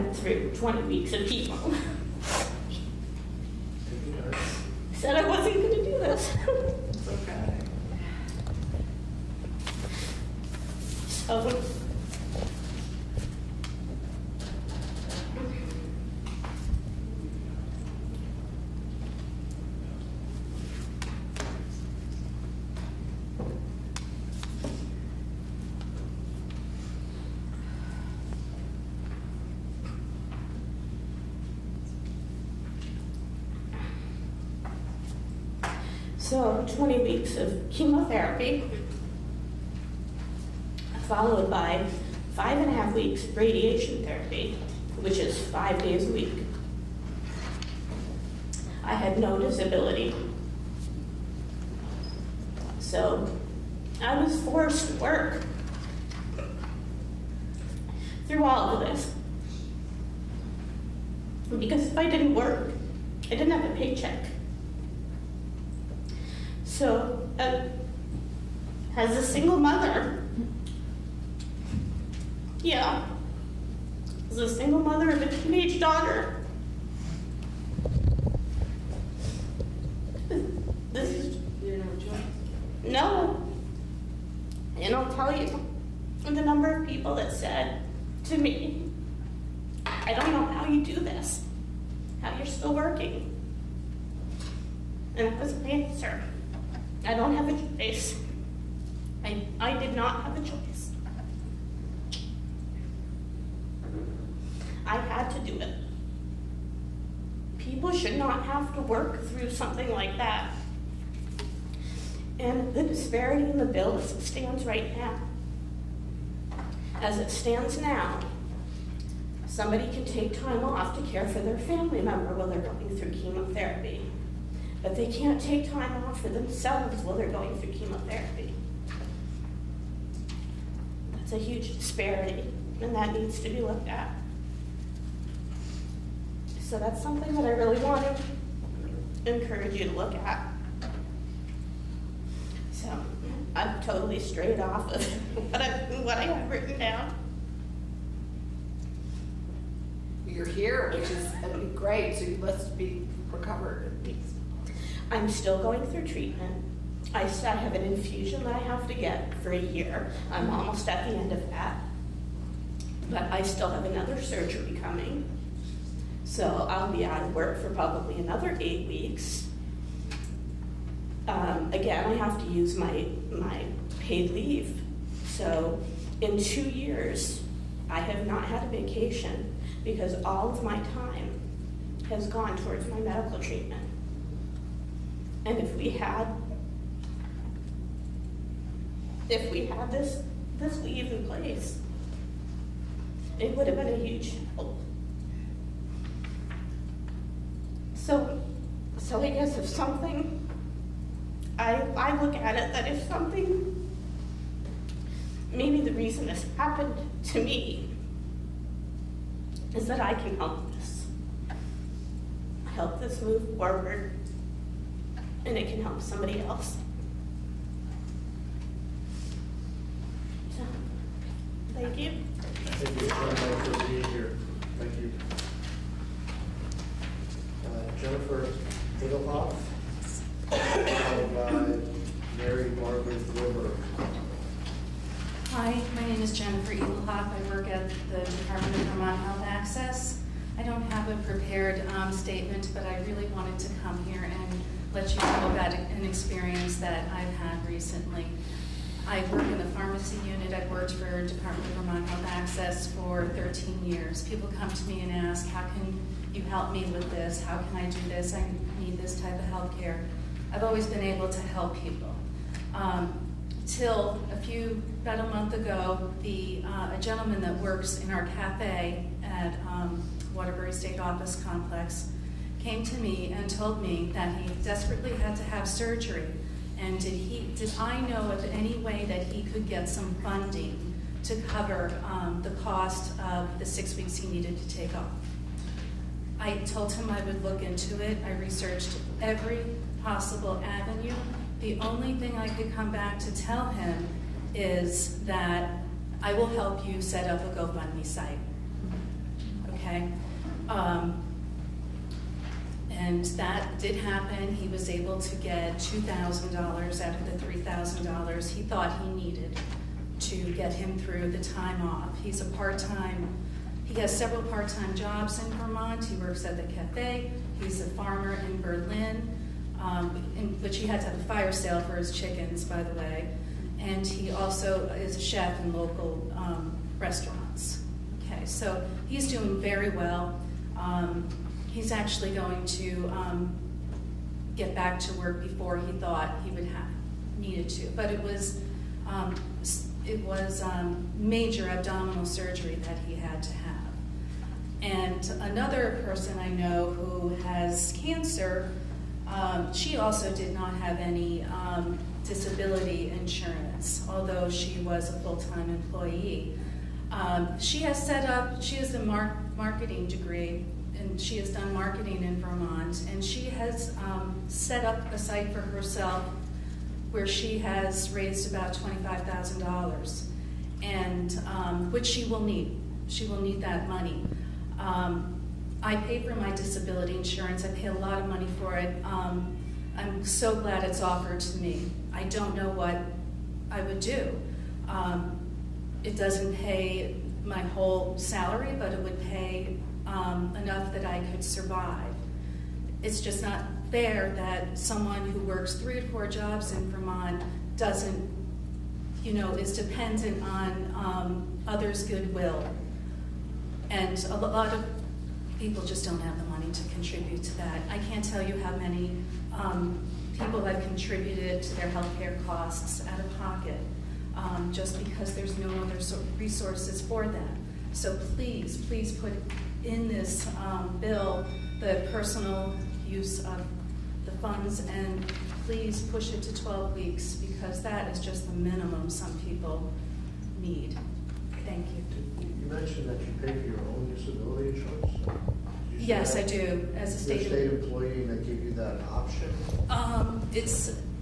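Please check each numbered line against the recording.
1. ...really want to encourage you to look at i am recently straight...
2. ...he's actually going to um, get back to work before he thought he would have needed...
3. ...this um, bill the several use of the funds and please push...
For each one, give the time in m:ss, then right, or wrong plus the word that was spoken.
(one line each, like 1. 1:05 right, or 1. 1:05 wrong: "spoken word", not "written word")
1. 2:17 wrong: "totally", not "recently"
2. 5:31 right
3. 7:00 wrong: "personal", not "several".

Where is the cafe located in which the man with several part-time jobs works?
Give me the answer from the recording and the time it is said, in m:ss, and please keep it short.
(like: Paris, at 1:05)
Waterbury State Office Complex, at 4:30.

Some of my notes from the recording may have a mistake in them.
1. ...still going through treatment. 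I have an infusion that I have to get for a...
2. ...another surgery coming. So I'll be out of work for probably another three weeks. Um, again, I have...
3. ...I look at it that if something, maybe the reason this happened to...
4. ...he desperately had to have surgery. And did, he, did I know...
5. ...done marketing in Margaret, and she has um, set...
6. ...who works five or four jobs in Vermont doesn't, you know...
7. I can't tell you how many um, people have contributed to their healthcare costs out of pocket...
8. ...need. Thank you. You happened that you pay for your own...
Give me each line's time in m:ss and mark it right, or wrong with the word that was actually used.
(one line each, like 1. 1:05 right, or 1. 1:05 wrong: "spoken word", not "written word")
1. 2:35 right
2. 2:43 wrong: "eight", not "three"
3. 3:21 right
4. 4:34 right
5. 6:01 wrong: "Vermont", not "Margaret"
6. 6:35 wrong: "three", not "five"
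7. 6:47 right
8. 7:10 wrong: "mentioned", not "happened".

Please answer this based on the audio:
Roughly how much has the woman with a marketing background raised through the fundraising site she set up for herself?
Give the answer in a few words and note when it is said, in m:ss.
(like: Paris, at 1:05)
$25,000, at 6:08.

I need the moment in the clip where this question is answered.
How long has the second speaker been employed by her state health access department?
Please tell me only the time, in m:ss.
4:13.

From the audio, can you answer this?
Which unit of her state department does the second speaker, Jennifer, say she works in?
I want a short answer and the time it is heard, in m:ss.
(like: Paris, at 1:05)
pharmacy unit, at 4:09.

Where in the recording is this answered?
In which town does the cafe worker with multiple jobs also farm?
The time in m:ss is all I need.
5:18.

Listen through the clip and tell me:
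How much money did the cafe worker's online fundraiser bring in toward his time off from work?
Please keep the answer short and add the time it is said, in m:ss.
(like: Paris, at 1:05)
$2,000, at 5:05.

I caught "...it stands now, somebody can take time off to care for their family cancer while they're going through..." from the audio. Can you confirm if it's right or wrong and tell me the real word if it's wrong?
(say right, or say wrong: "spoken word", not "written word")
wrong: "member", not "cancer".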